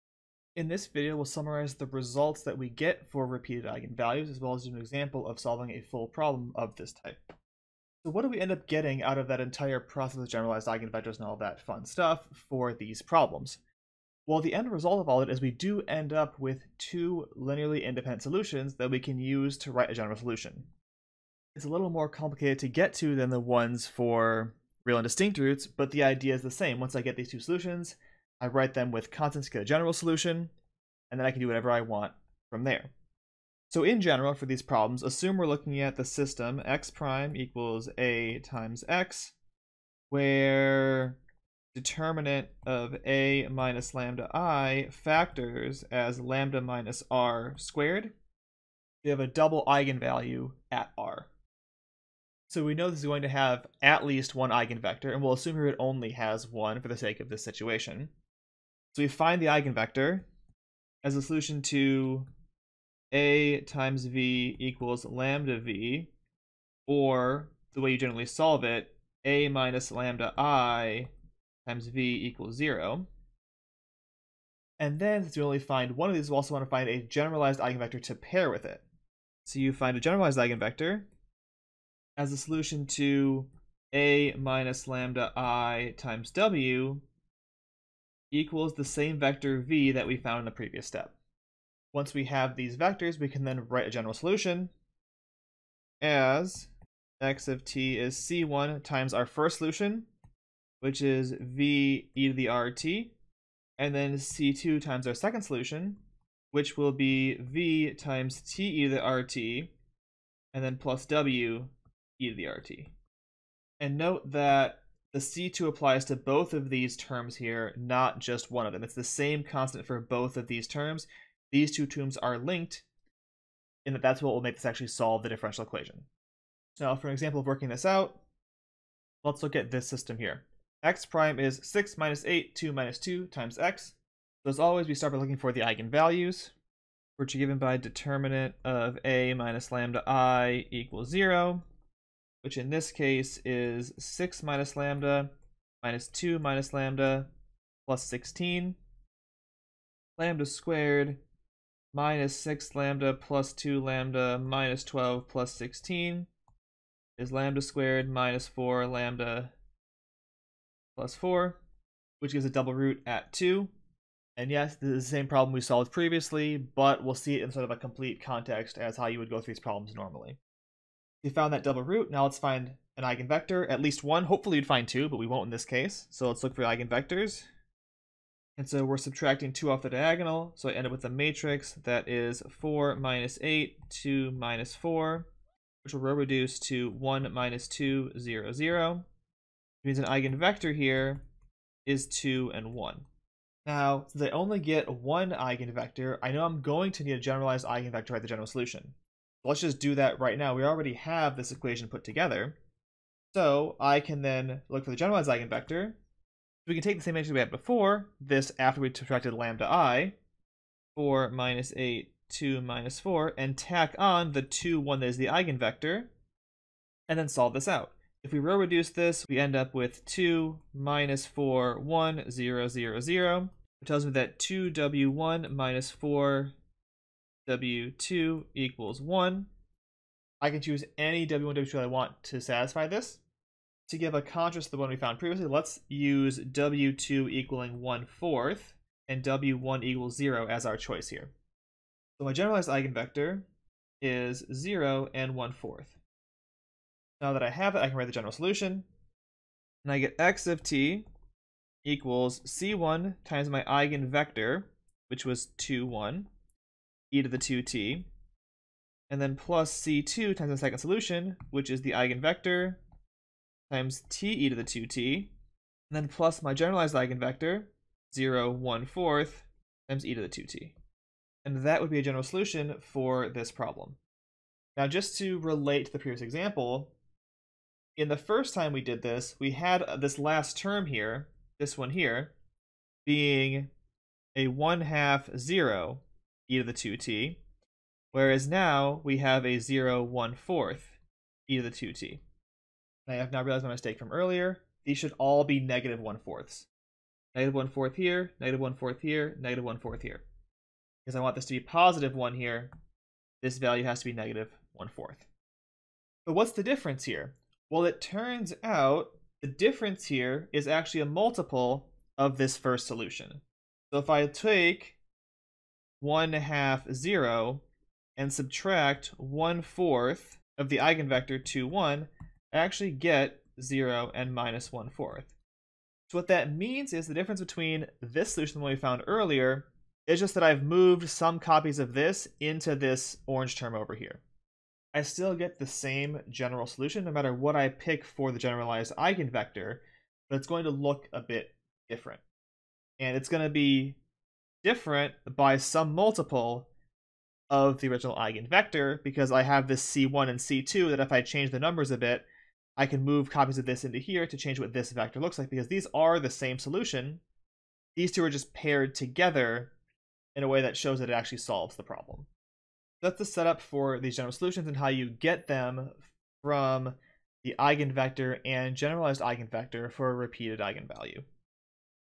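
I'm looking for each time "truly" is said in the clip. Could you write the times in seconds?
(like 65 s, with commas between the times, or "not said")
not said.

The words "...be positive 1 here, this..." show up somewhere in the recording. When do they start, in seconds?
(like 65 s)
301 s.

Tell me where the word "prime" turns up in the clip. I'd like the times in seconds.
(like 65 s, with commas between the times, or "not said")
36 s, 131 s.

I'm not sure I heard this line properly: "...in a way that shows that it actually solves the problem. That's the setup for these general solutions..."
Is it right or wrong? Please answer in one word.
right.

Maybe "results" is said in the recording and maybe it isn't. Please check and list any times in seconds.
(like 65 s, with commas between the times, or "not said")
1 s, 14 s.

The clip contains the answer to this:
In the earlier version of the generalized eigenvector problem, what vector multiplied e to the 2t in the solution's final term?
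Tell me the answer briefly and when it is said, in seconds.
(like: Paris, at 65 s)
(1/2, 0), at 284 s.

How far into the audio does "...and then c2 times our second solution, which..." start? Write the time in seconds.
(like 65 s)
103 s.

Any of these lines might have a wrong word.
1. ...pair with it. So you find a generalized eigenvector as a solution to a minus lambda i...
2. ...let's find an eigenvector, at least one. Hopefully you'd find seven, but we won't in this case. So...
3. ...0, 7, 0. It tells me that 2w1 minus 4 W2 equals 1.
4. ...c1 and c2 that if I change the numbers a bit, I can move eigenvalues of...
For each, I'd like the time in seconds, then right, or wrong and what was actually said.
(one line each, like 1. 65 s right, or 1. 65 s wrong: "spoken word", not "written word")
1. 78 s right
2. 172 s wrong: "two", not "seven"
3. 222 s wrong: "0", not "7"
4. 349 s wrong: "copies", not "eigenvalues".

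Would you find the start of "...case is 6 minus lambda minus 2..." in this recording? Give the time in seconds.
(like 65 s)
142 s.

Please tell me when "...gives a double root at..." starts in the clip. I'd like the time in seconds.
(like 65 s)
162 s.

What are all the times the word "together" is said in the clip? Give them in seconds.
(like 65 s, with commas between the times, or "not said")
202 s, 358 s.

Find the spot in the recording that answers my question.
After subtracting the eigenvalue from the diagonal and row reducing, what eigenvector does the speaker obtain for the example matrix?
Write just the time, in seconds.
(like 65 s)
192 s.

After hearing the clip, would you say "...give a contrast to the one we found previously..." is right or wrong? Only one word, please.
right.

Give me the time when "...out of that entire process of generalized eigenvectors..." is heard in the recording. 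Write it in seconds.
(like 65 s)
9 s.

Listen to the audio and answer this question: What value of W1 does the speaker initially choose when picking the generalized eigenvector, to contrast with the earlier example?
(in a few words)
0.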